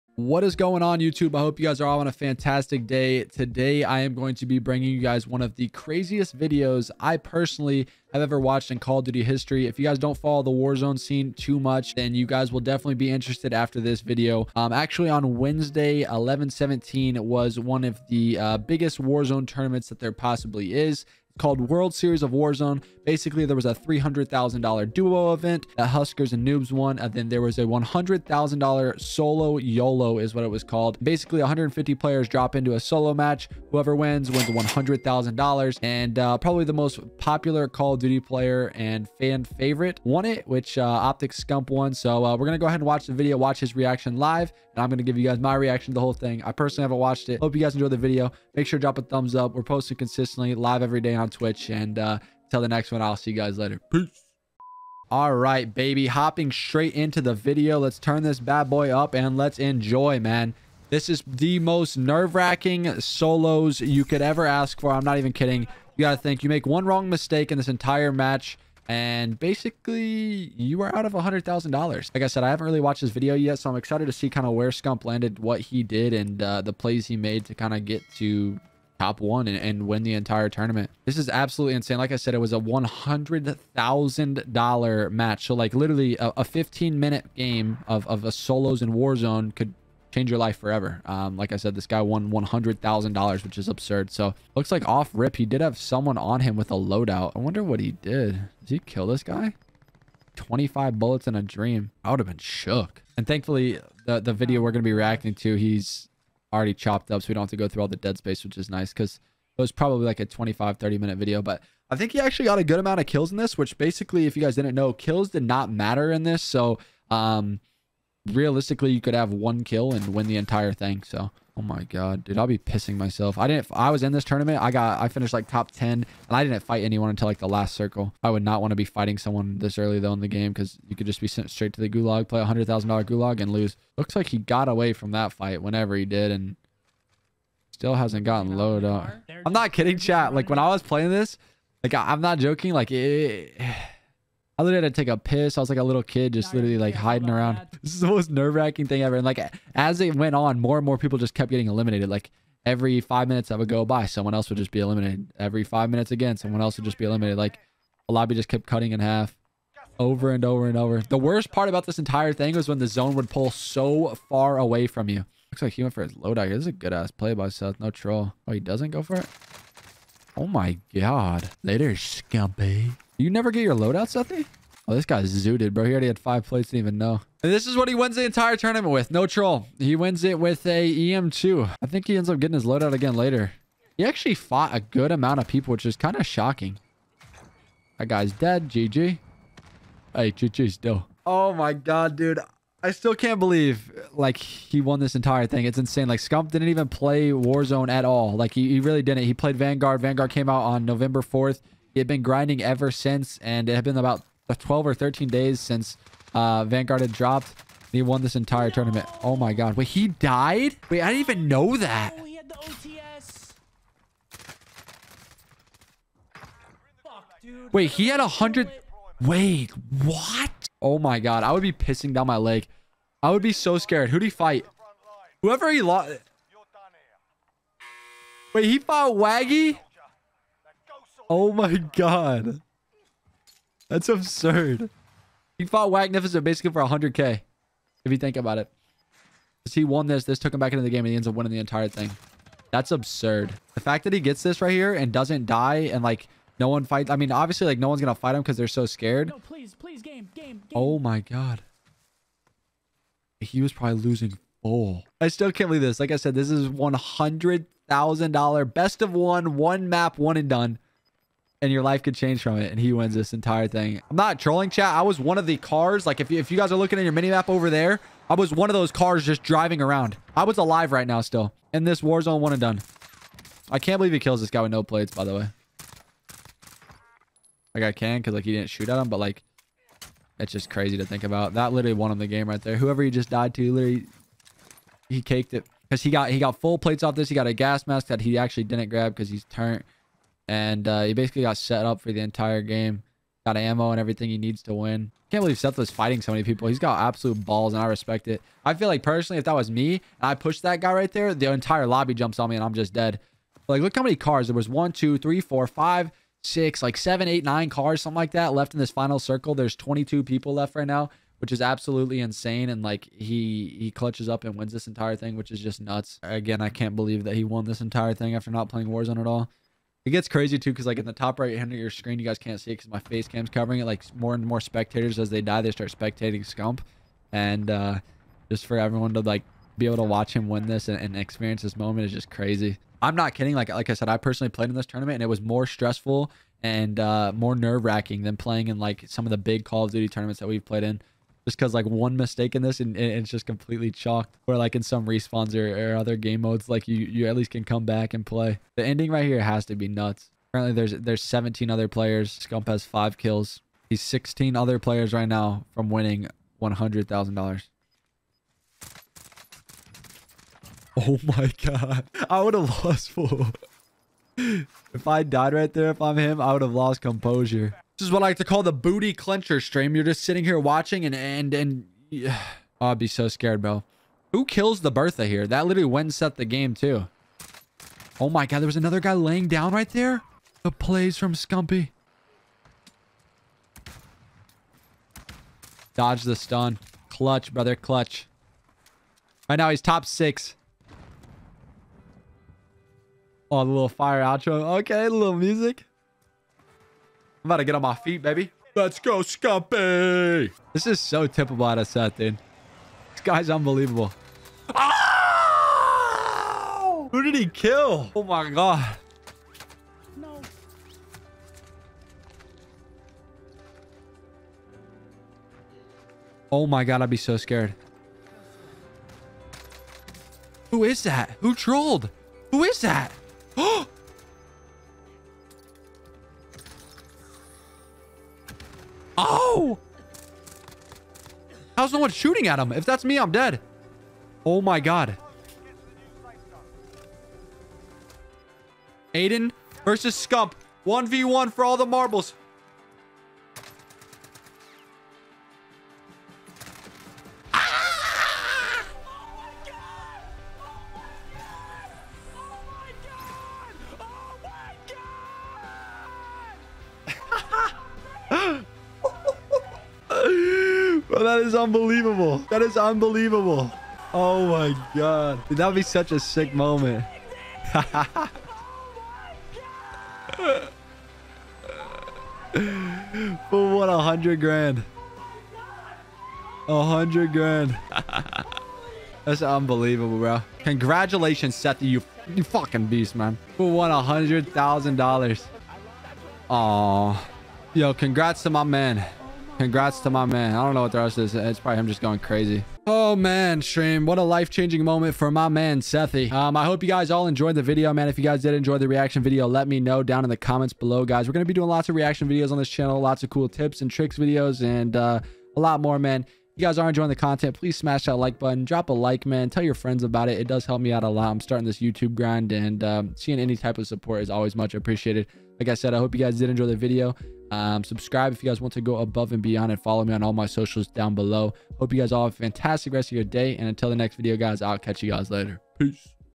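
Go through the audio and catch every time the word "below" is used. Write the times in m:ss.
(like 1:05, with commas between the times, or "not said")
8:20, 8:41.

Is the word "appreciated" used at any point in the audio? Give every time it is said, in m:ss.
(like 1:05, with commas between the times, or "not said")
8:34.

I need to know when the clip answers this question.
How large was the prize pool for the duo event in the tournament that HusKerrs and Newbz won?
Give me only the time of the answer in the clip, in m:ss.
0:23.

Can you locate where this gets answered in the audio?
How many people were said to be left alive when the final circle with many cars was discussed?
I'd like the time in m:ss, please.
5:09.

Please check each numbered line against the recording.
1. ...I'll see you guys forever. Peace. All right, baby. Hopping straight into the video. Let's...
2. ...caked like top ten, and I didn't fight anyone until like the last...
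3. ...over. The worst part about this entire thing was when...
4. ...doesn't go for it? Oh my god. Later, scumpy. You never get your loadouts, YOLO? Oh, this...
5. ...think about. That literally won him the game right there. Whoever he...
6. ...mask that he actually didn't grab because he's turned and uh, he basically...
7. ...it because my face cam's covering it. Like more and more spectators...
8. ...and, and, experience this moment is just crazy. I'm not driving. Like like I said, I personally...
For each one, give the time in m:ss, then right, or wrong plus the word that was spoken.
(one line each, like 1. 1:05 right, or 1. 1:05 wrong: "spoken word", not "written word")
1. 0:53 wrong: "later", not "forever"
2. 2:05 wrong: "finished", not "caked"
3. 2:40 right
4. 2:48 wrong: "Sethy", not "YOLO"
5. 4:41 right
6. 4:47 right
7. 5:22 right
8. 5:30 wrong: "kidding", not "driving".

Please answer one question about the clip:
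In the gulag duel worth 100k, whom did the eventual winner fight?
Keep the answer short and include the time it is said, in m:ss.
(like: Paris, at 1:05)
Wagnificent, at 3:55.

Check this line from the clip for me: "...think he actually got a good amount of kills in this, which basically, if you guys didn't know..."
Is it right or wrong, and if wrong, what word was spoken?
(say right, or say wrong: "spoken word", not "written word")
right.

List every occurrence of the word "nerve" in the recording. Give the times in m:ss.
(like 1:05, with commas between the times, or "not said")
1:01, 2:28, 5:37.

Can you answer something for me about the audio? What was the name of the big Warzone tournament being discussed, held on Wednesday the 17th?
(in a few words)
World Series of Warzone.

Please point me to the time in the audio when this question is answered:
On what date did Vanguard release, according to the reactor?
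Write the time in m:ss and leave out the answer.
3:20.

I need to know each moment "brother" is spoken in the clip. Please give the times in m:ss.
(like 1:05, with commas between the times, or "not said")
6:27.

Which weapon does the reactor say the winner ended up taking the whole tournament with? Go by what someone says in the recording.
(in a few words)
EM2.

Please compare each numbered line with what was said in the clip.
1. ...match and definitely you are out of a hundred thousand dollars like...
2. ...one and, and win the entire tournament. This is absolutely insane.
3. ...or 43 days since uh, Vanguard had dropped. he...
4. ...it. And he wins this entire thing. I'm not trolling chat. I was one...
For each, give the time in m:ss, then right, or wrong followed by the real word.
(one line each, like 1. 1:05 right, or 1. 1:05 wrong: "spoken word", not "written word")
1. 1:08 wrong: "basically", not "definitely"
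2. 1:19 right
3. 3:24 wrong: "13", not "43"
4. 4:22 right.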